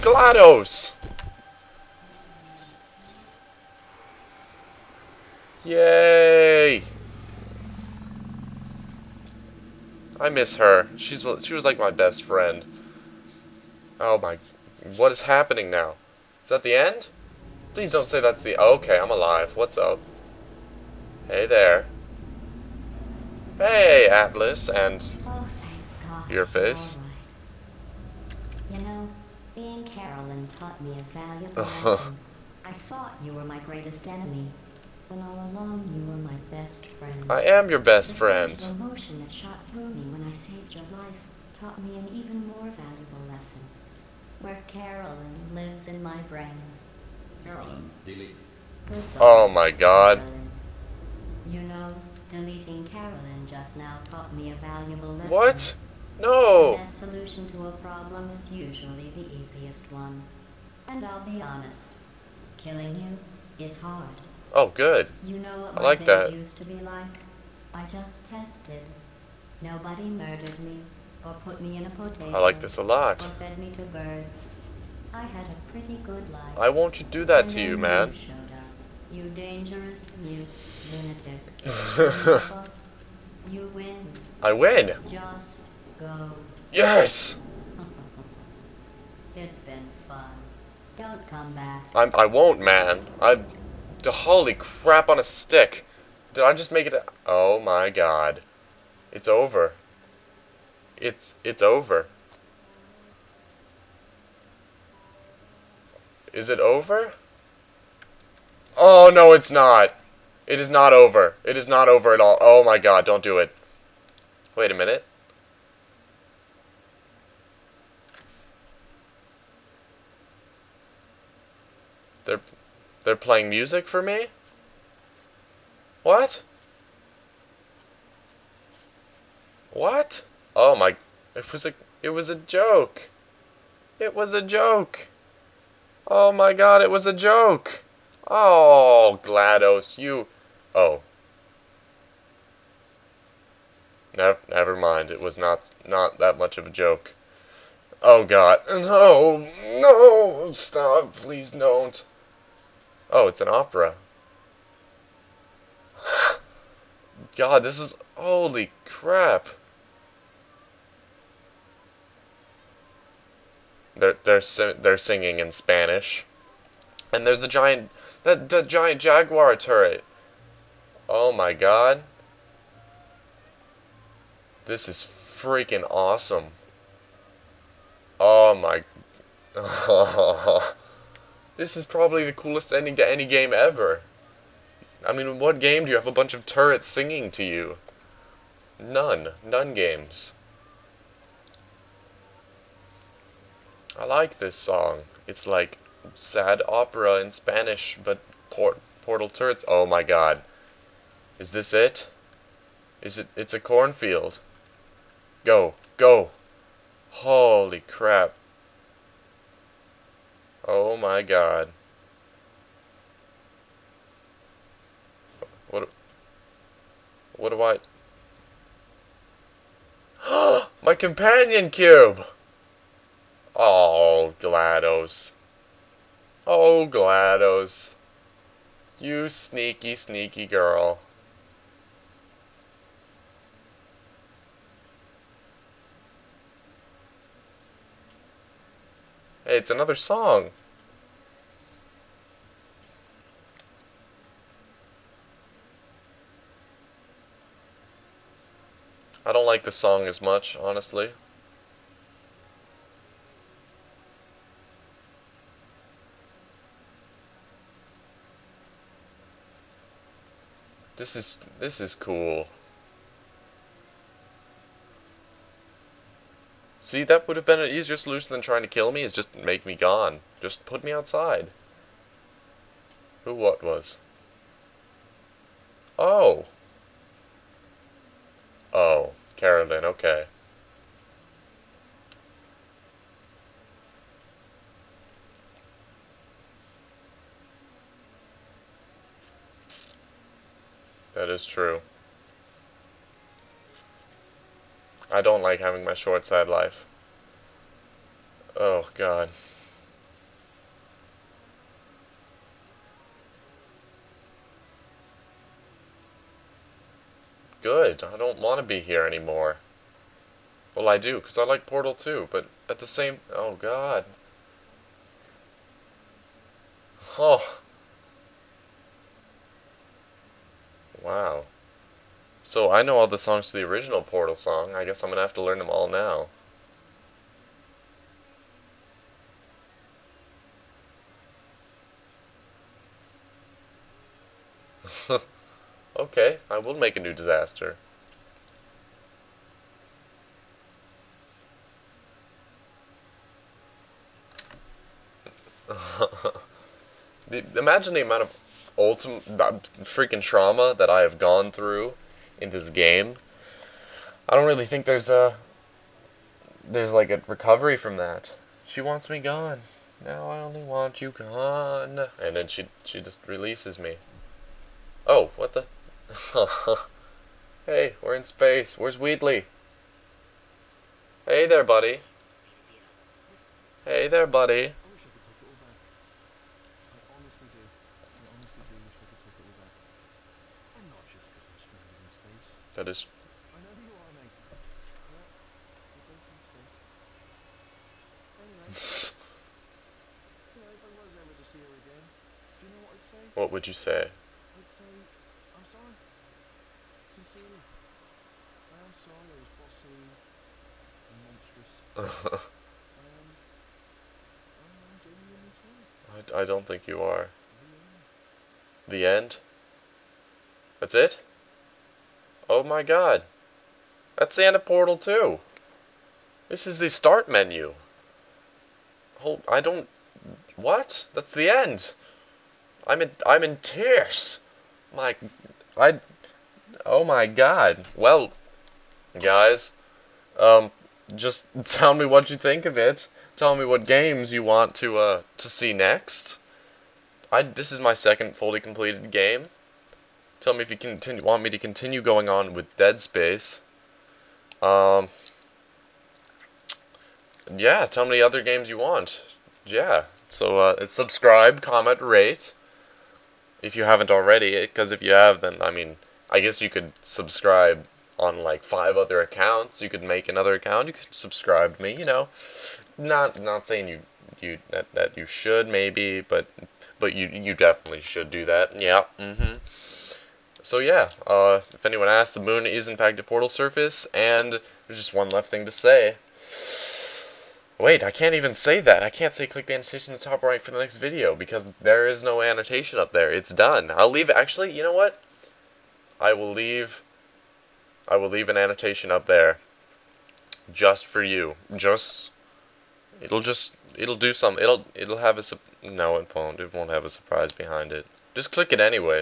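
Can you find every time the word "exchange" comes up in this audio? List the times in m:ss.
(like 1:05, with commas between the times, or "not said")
not said.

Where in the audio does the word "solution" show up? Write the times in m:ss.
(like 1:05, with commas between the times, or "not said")
0:56, 4:27.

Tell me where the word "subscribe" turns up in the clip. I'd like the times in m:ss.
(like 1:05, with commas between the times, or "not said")
7:30, 7:36, 7:41.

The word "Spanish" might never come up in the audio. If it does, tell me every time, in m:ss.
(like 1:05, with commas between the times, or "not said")
2:45, 3:17.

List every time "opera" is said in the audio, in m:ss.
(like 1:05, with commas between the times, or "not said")
2:33, 3:16.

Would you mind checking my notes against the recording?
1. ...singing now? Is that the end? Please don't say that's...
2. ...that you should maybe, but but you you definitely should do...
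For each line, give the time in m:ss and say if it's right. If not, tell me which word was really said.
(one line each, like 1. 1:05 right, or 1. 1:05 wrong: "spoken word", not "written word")
1. 0:15 wrong: "happening", not "singing"
2. 7:44 right.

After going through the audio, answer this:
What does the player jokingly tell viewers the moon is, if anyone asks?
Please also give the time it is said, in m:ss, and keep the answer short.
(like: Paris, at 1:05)
A portal surface, at 7:53.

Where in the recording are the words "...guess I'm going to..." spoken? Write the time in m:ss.
5:24.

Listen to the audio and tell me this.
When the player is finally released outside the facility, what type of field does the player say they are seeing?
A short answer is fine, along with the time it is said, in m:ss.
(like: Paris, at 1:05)
Cornfield, at 3:23.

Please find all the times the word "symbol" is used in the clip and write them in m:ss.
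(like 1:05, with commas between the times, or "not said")
not said.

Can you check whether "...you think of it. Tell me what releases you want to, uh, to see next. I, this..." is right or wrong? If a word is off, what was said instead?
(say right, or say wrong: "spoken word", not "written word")
wrong: "games", not "releases".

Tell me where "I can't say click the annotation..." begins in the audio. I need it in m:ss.
7:59.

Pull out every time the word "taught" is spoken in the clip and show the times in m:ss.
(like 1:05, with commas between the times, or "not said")
0:30, 0:41, 0:54.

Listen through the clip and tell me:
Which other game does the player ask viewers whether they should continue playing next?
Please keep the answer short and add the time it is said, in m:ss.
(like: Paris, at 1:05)
Dead Space, at 7:22.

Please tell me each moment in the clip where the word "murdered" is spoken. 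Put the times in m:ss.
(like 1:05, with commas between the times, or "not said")
1:10.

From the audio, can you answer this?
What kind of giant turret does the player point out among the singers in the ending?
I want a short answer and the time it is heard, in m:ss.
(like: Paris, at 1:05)
Jaguar turret, at 2:48.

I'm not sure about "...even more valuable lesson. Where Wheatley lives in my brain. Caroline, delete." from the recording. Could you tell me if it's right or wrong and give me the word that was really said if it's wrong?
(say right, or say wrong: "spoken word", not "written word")
wrong: "Caroline", not "Wheatley".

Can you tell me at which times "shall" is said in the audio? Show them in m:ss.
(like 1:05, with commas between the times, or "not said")
not said.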